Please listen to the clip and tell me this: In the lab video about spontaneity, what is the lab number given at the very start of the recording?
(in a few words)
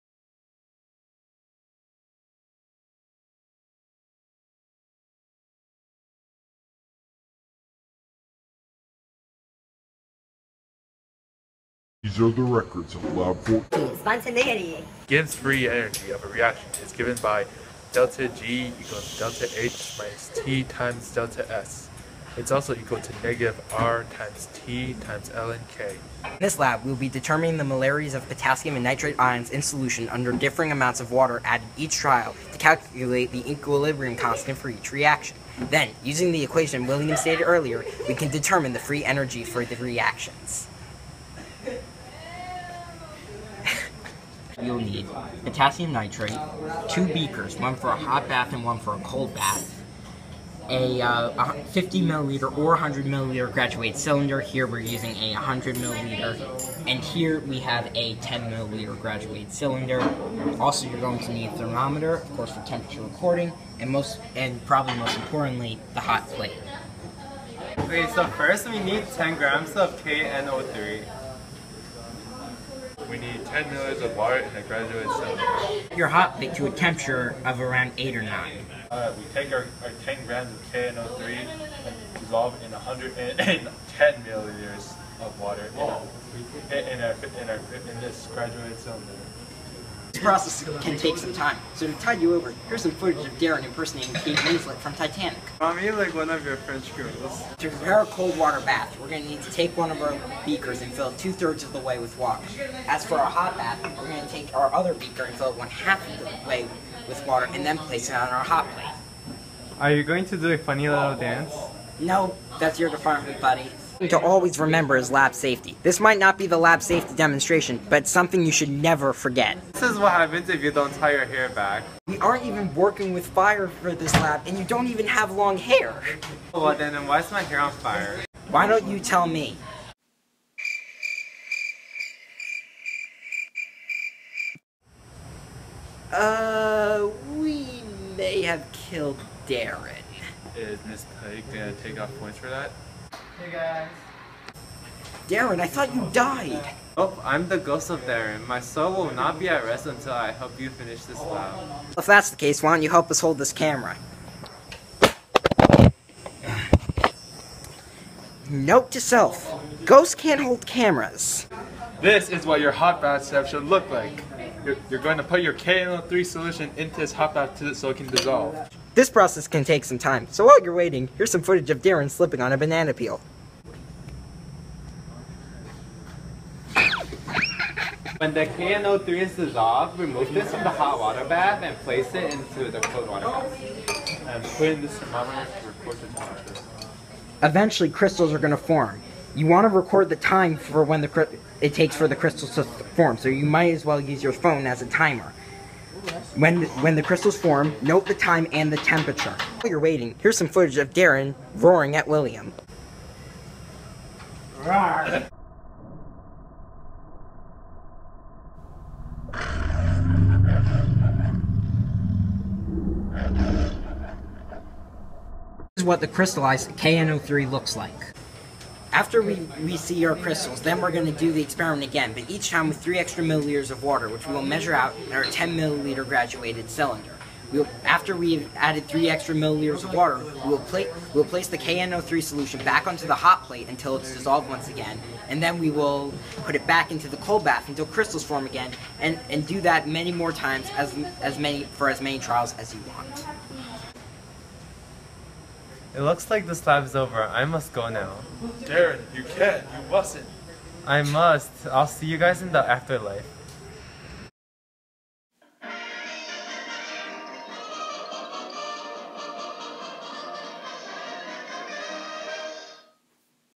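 14.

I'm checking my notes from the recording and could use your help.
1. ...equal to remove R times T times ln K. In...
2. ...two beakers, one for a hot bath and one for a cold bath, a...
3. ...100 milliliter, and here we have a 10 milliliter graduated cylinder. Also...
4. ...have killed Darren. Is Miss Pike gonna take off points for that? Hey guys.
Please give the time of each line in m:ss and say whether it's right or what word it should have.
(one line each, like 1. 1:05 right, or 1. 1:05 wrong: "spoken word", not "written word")
1. 0:22 wrong: "negative", not "remove"
2. 0:46 right
3. 0:55 right
4. 2:18 right.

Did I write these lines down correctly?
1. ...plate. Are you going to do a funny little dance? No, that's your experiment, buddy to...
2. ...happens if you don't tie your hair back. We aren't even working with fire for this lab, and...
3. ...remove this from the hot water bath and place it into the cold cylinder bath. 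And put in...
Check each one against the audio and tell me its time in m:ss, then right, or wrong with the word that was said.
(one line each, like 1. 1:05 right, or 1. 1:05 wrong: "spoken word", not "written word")
1. 1:48 wrong: "department", not "experiment"
2. 2:00 right
3. 2:59 wrong: "water", not "cylinder".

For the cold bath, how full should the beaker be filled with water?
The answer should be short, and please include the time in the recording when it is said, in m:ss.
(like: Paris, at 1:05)
two-thirds, at 1:41.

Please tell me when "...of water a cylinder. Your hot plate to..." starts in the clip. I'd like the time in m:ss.
1:14.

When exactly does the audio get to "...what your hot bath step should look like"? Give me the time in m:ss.
2:42.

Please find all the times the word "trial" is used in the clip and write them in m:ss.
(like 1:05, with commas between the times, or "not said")
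0:31, 4:02.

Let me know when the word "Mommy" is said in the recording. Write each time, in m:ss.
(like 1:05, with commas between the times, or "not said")
1:35.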